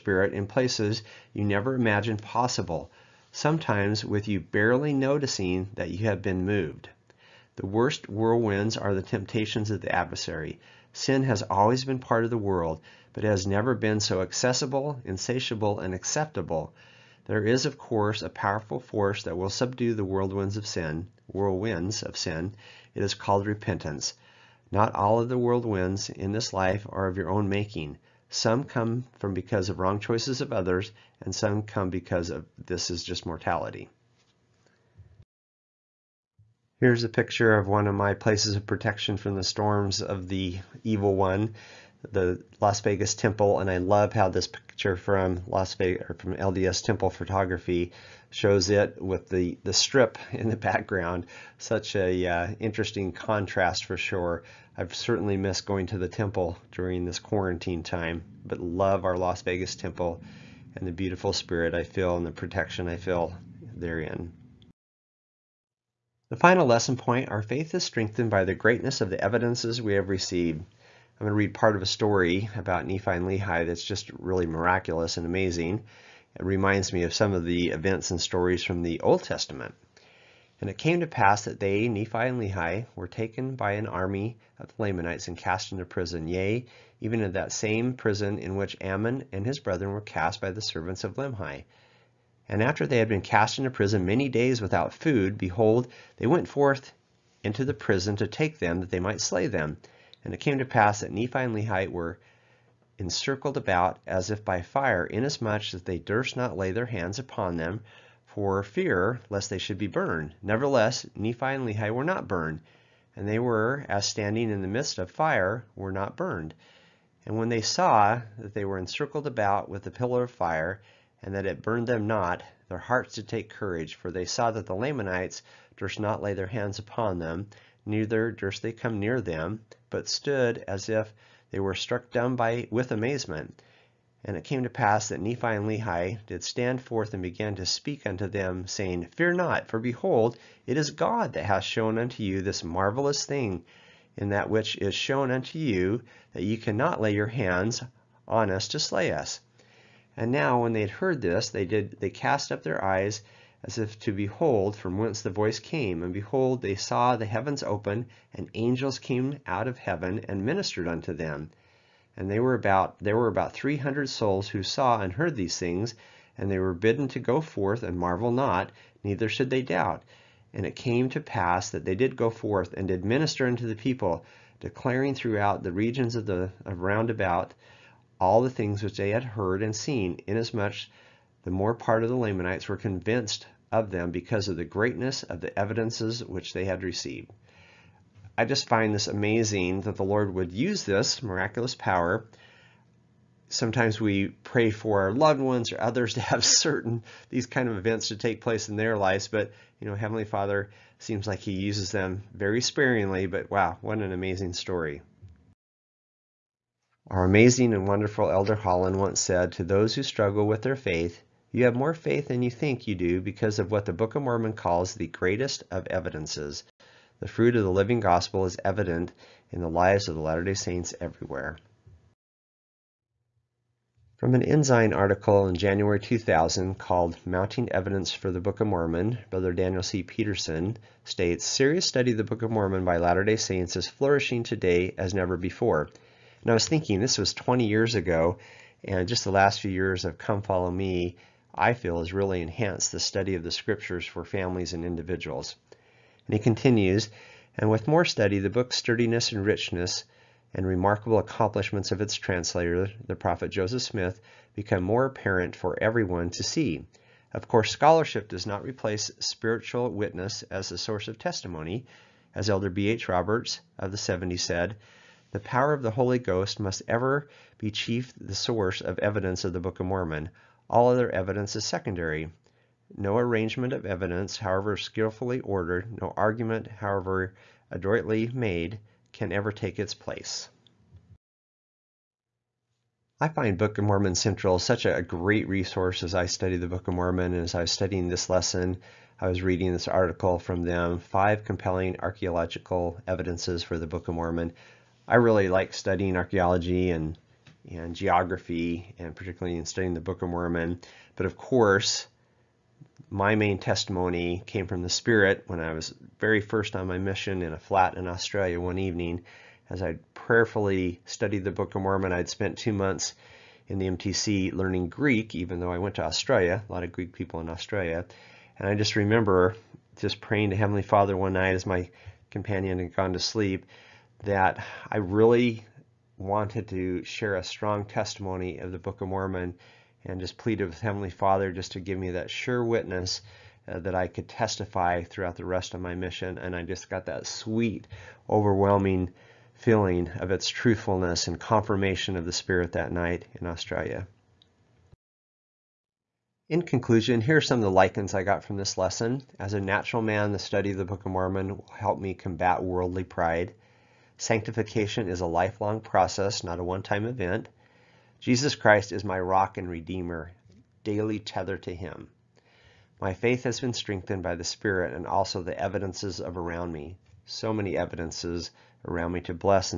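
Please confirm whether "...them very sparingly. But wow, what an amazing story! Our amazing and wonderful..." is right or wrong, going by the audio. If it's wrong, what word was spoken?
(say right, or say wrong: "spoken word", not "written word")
right.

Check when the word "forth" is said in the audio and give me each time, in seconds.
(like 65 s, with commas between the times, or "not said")
96 s, 136 s, 167 s, 172 s.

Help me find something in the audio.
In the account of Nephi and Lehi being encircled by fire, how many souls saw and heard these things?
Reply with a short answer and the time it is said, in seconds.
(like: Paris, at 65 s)
300, at 163 s.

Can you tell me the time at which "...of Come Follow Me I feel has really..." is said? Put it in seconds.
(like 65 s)
240 s.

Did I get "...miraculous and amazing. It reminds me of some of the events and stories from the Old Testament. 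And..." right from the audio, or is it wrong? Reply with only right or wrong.
right.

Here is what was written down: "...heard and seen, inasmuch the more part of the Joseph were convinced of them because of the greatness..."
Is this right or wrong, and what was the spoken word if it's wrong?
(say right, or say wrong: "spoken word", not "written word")
wrong: "Lamanites", not "Joseph".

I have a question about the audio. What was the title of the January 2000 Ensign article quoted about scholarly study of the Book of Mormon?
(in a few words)
Mounting Evidence for the Book of Mormon.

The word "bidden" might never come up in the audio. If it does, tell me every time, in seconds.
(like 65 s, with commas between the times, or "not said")
166 s.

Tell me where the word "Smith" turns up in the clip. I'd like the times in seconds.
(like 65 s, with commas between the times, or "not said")
253 s.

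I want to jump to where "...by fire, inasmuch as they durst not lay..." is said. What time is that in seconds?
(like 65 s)
104 s.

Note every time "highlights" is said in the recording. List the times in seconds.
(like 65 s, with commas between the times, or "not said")
not said.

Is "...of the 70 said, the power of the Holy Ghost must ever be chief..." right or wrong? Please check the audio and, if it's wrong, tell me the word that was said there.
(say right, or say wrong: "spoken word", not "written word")
right.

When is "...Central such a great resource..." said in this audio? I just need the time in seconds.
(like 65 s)
284 s.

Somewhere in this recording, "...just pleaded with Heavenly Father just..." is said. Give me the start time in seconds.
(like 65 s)
330 s.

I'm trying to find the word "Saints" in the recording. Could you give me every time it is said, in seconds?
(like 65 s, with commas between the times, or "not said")
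220 s, 233 s.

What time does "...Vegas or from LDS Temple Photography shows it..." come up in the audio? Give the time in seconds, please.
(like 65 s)
45 s.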